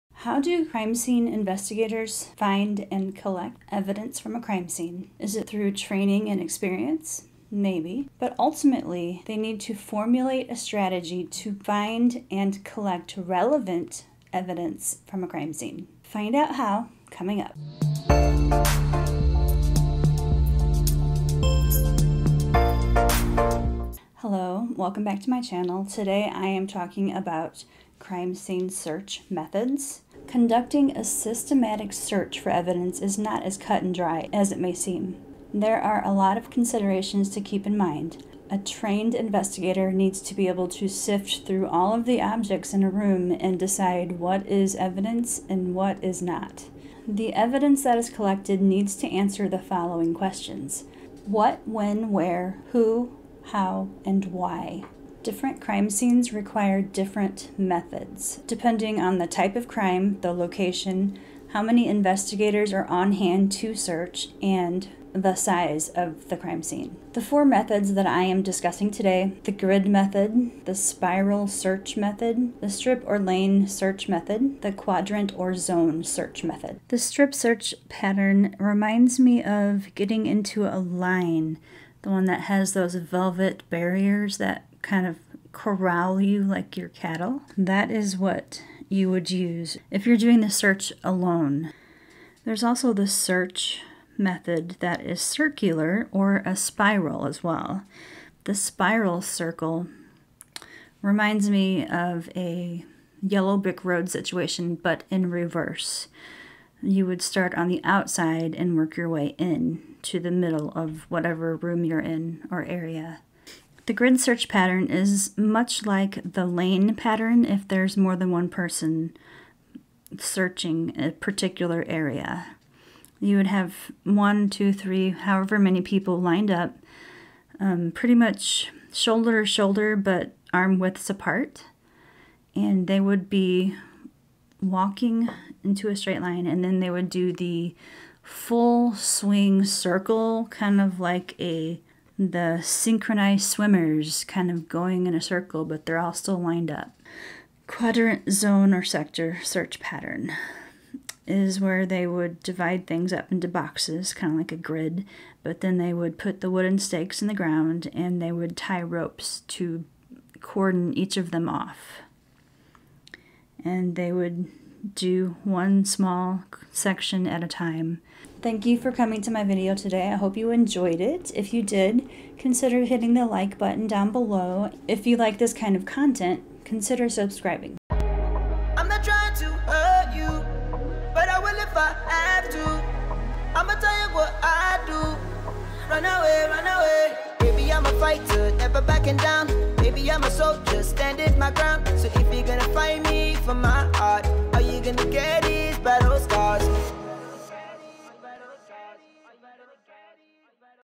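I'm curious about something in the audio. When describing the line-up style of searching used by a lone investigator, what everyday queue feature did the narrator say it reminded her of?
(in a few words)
velvet barriers.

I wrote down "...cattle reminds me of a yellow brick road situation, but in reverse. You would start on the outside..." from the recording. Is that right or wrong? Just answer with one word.
wrong.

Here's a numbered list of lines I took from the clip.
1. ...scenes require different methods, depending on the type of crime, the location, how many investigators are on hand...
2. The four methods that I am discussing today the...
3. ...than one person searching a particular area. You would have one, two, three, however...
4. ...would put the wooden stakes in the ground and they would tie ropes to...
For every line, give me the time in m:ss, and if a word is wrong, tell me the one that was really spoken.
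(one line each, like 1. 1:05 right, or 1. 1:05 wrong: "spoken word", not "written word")
1. 0:55 right
2. 1:07 right
3. 1:58 right
4. 2:35 right.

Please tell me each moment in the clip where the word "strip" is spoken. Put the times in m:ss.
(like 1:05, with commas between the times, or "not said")
1:12, 1:16.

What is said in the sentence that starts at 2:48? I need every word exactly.
Thank you for coming to my video today.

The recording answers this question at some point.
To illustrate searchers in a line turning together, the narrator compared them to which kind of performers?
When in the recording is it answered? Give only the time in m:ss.
2:22.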